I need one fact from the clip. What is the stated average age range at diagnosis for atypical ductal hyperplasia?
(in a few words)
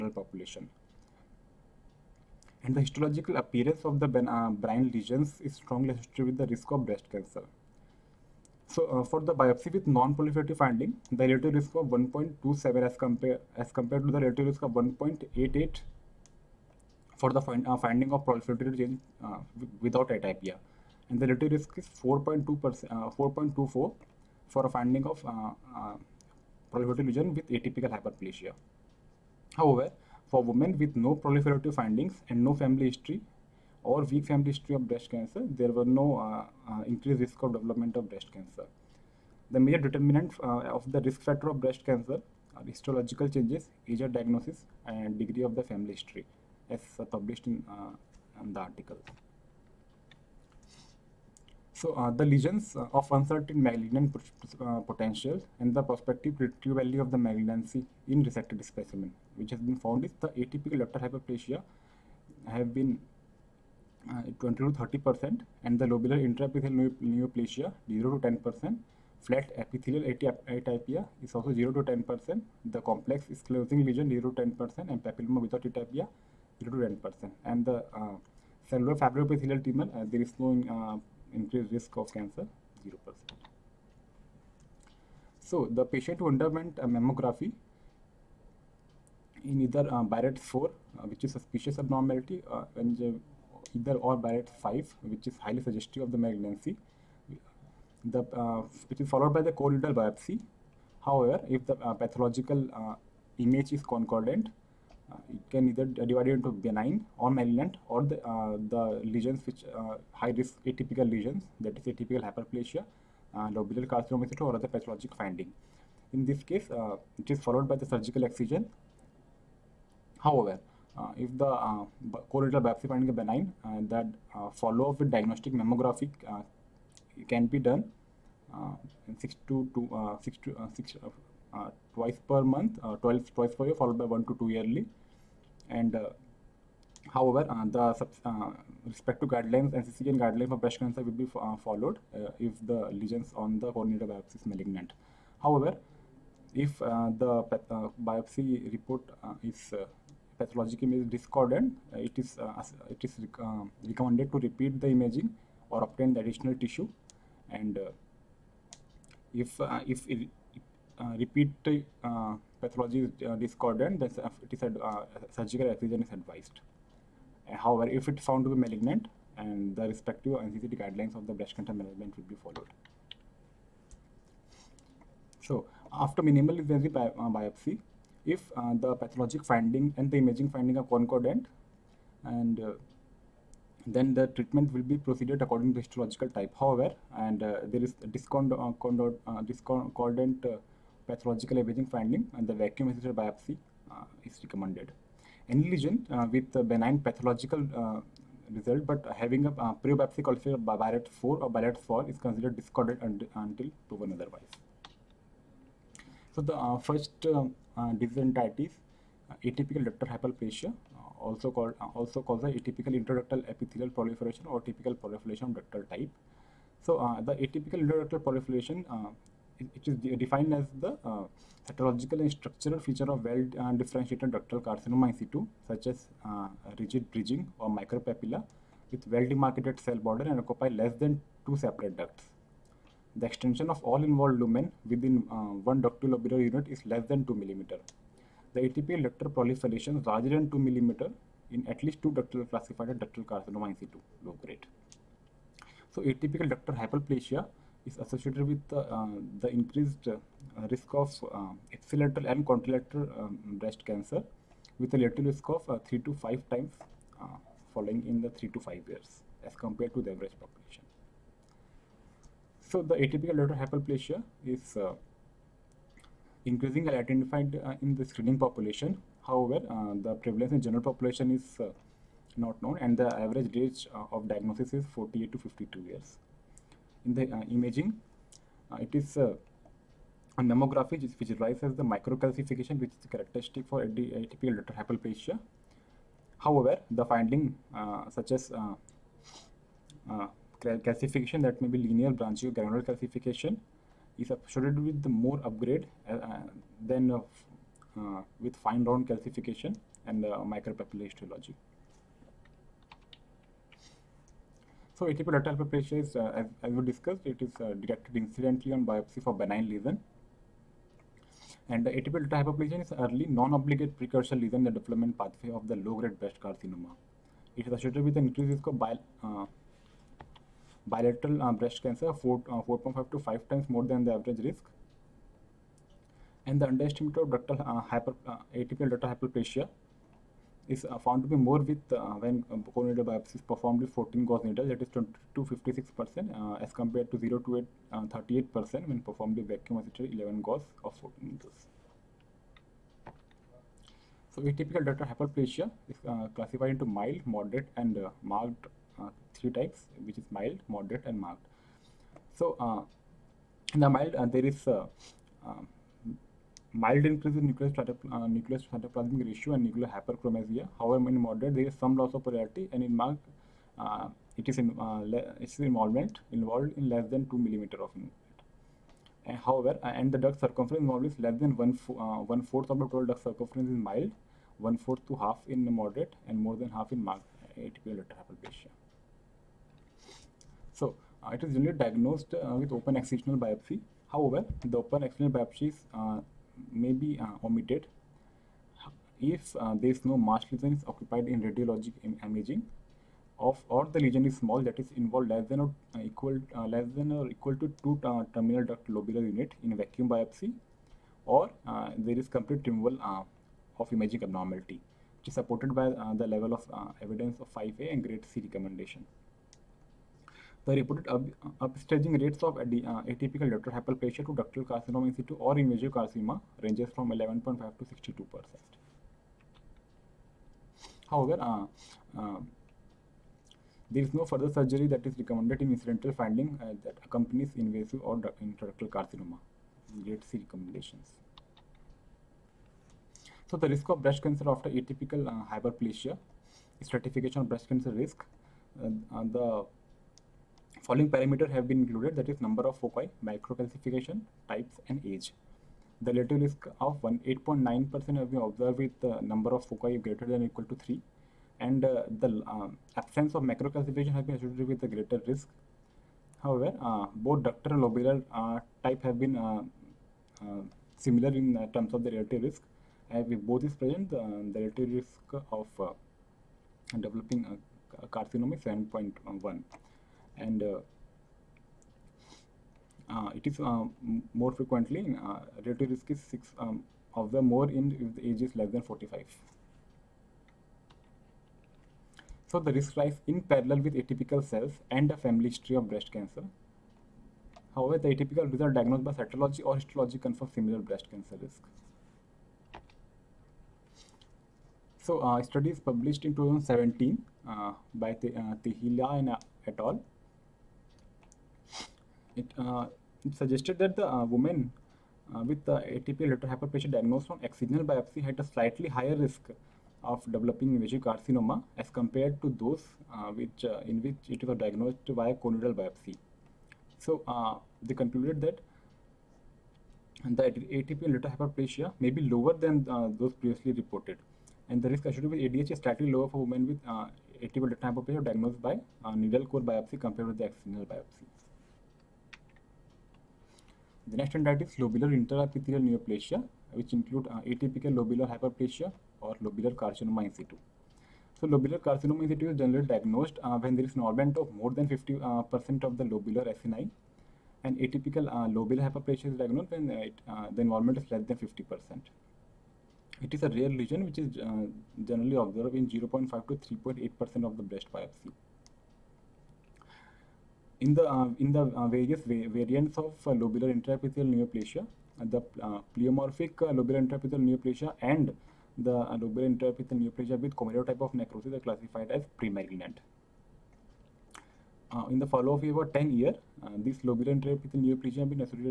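48 to 52 years.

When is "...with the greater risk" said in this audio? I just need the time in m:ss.
7:34.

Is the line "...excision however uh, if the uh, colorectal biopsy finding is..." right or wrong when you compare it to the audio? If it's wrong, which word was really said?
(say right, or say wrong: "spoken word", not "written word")
right.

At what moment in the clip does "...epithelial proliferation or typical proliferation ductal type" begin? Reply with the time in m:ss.
3:33.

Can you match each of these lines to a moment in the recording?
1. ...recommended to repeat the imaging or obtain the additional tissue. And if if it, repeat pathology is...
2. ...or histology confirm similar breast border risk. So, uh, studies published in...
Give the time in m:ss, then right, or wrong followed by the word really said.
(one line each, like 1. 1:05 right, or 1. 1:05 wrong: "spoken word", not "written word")
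1. 2:33 right
2. 8:09 wrong: "cancer", not "border".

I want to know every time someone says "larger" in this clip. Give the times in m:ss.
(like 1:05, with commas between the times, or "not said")
4:00.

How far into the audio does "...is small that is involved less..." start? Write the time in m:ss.
6:34.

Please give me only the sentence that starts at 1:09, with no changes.
Flat epithelial atypia is also 0 to 10 percent.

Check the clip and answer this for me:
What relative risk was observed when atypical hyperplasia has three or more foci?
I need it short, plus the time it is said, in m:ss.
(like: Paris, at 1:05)
8.9%, at 7:27.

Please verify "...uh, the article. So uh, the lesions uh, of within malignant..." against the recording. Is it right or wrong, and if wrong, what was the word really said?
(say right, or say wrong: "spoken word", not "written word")
wrong: "uncertain", not "within".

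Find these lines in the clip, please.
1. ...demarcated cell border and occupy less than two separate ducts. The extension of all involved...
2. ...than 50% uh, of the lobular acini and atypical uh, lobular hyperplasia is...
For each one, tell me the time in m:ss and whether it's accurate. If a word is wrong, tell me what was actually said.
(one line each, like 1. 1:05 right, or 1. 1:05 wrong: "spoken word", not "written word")
1. 3:49 right
2. 9:04 right.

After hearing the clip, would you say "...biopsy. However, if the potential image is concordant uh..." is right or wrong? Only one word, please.
wrong.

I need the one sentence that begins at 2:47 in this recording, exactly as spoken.
Uh, however, if it's found to be malignant, and the respective NCCN guidelines of the breast cancer management will be followed.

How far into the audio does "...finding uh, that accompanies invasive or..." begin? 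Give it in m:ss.
7:06.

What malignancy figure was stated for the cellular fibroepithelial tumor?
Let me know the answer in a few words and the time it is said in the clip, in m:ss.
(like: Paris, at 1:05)
0 percent, at 1:22.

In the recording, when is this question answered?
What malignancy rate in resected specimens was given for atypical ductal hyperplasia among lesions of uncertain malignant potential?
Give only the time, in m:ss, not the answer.
1:04.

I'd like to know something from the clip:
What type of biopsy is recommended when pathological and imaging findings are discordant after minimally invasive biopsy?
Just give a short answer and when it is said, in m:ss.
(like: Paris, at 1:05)
vacuum assisted biopsy, at 3:12.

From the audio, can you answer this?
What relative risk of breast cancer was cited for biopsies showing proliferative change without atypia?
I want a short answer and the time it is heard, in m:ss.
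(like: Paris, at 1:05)
1.88, at 0:14.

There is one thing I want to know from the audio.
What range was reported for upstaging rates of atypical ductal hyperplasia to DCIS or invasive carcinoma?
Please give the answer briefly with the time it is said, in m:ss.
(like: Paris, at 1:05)
11.5 to 62 percent, at 6:57.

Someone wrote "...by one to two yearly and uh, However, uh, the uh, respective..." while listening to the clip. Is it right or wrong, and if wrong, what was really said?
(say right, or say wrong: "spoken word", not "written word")
right.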